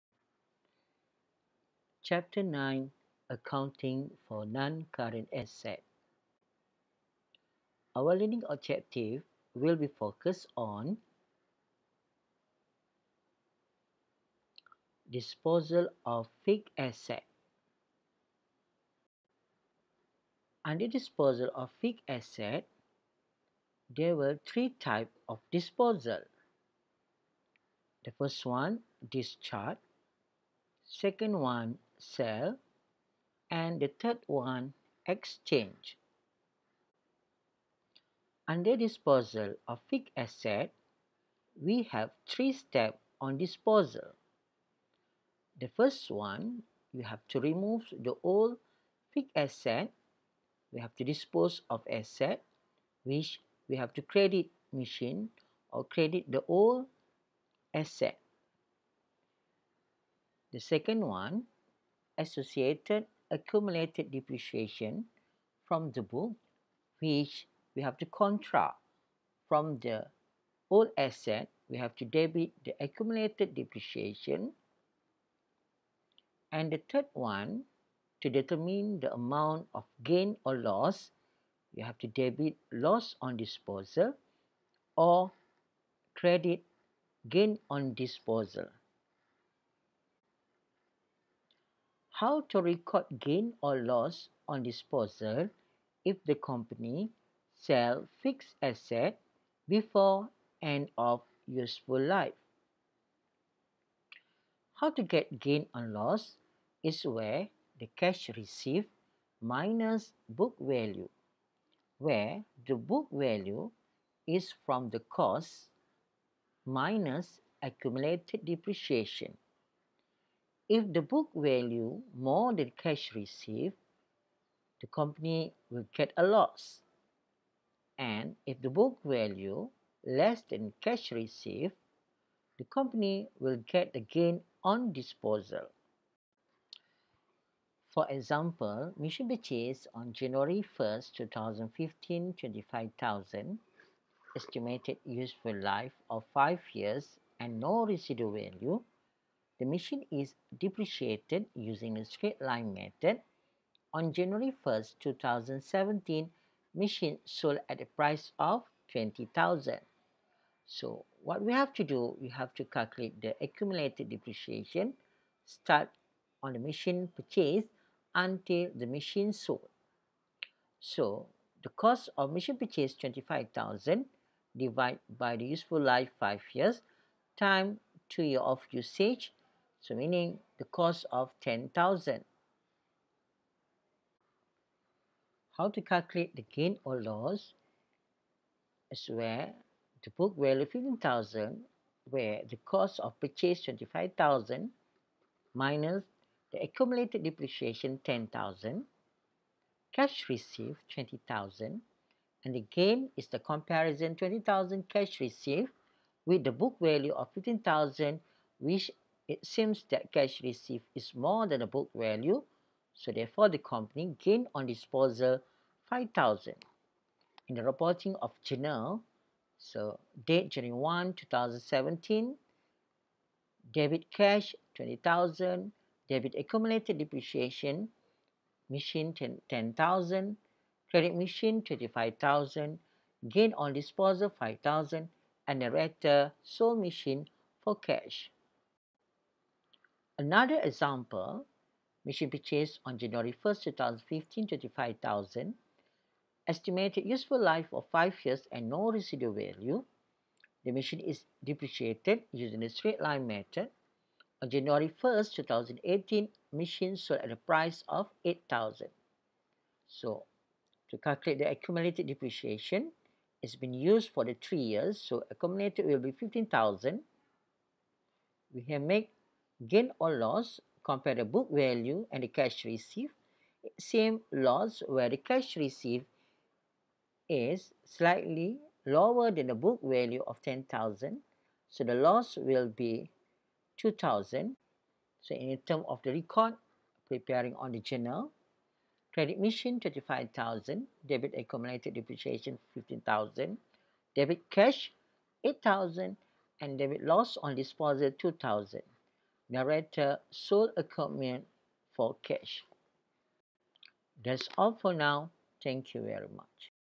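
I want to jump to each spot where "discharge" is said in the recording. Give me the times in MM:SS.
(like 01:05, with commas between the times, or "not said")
00:29.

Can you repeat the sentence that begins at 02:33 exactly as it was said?
On January first, two 2017, machine sold at a price of 20,000.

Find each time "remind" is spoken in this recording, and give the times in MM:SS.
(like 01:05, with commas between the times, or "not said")
not said.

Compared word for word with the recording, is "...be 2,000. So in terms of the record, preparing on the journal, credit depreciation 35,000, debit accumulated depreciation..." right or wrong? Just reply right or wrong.
wrong.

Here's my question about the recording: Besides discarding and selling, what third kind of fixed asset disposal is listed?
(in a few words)
exchange.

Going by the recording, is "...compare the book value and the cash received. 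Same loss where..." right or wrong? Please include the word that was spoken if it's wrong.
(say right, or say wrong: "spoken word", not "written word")
right.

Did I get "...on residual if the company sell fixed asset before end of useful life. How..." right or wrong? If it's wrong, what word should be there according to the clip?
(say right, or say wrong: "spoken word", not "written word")
wrong: "disposal", not "residual".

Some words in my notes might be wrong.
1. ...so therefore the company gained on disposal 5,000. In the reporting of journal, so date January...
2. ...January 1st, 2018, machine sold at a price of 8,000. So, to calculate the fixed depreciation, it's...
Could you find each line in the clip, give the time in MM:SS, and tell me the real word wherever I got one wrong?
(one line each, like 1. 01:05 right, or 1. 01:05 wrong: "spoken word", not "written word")
1. 03:32 right
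2. 04:14 wrong: "accumulated", not "fixed".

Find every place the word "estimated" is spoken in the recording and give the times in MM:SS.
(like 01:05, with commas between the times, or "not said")
02:24, 04:06.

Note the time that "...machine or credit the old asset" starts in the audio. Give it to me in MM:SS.
00:54.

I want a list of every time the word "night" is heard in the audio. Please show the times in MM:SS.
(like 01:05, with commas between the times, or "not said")
not said.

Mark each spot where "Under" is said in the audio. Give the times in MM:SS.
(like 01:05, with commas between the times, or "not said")
00:20, 00:38.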